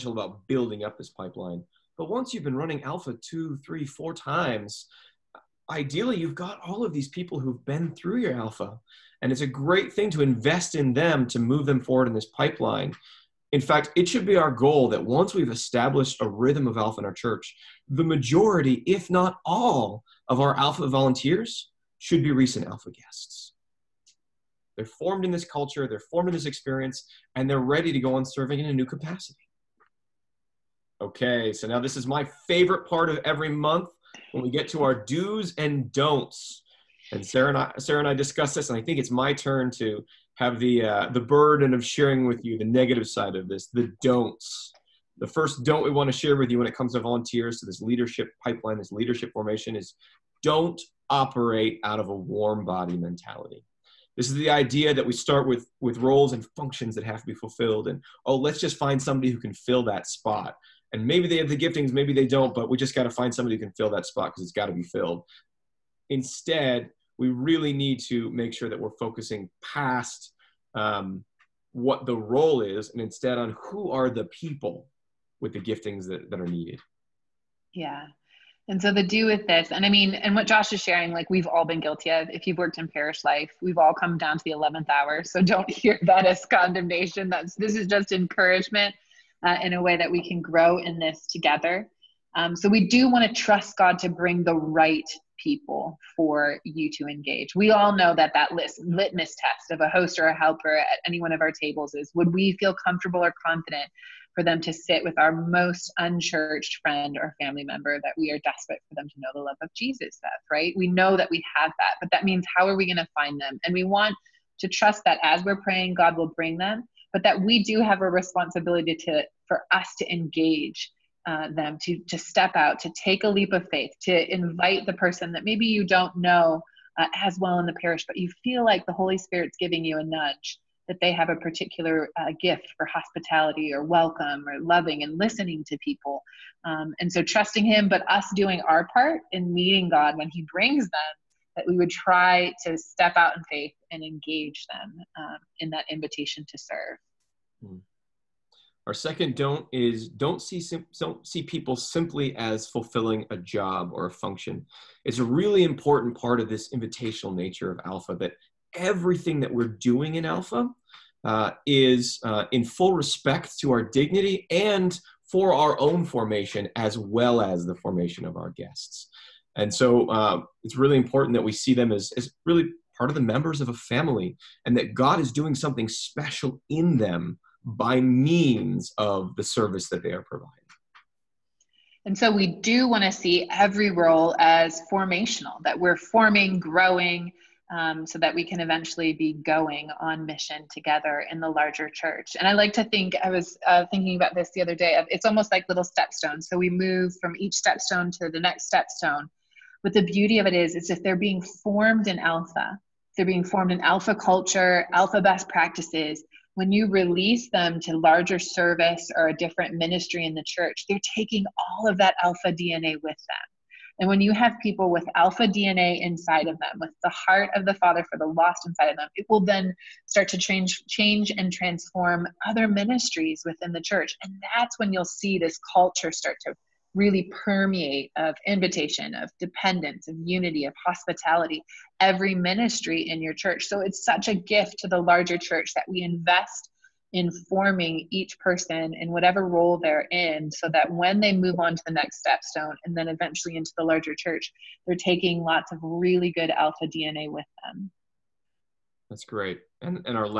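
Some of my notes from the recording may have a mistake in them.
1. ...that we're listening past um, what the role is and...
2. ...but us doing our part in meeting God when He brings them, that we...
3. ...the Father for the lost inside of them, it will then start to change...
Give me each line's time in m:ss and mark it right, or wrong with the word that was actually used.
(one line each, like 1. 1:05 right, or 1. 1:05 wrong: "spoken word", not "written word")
1. 1:08 wrong: "focusing", not "listening"
2. 2:17 right
3. 3:37 right.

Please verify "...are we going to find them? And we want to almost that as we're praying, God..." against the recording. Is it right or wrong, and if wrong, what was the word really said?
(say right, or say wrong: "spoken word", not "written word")
wrong: "trust", not "almost".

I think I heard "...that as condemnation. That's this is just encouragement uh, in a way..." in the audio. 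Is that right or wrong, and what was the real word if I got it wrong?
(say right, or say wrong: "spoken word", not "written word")
right.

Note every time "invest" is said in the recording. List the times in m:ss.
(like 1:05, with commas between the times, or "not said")
0:10, 3:56.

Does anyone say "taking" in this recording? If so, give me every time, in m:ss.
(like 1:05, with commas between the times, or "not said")
3:31, 4:04.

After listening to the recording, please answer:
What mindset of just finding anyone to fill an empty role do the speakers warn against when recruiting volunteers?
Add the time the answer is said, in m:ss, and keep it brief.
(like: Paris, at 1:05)
Warm body mentality, at 0:52.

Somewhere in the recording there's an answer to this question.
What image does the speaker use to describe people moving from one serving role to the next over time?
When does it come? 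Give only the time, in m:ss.
3:15.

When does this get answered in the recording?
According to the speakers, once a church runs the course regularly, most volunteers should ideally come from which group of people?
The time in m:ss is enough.
0:22.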